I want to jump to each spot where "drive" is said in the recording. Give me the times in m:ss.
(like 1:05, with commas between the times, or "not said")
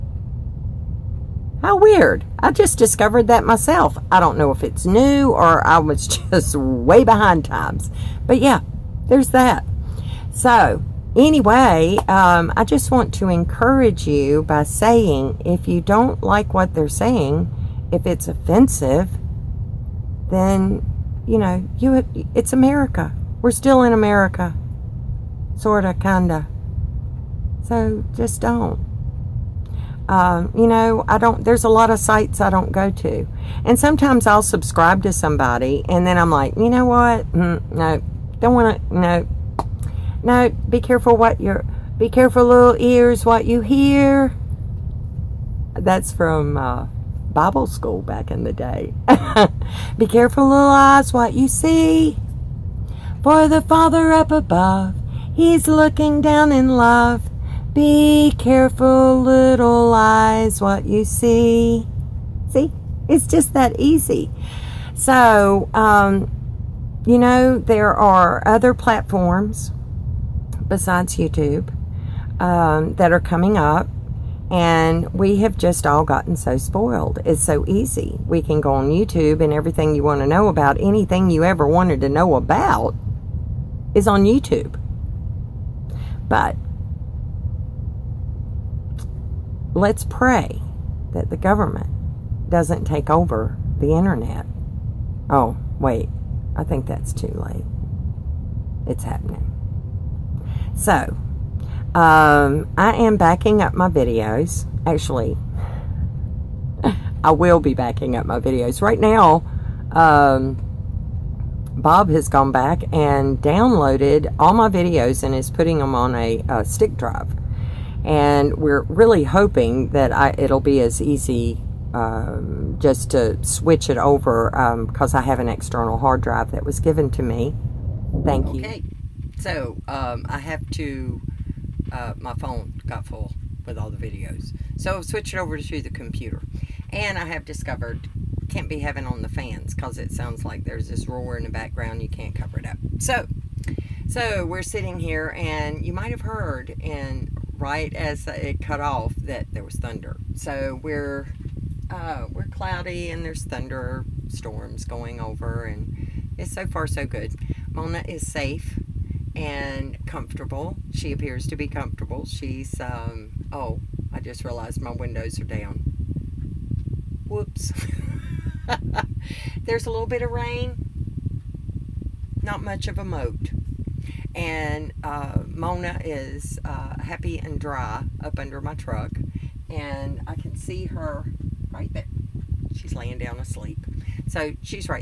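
1:56, 2:06.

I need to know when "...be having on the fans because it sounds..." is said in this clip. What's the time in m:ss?
2:18.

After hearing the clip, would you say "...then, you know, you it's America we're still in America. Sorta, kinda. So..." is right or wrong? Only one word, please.
right.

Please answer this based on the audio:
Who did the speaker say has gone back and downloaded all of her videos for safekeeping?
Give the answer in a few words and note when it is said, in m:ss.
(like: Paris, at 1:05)
Bob, at 1:51.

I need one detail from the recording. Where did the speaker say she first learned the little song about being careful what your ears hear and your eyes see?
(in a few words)
Bible school.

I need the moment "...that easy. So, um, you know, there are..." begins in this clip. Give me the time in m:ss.
1:03.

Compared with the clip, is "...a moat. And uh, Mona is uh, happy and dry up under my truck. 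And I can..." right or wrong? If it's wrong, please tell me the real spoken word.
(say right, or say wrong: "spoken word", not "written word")
right.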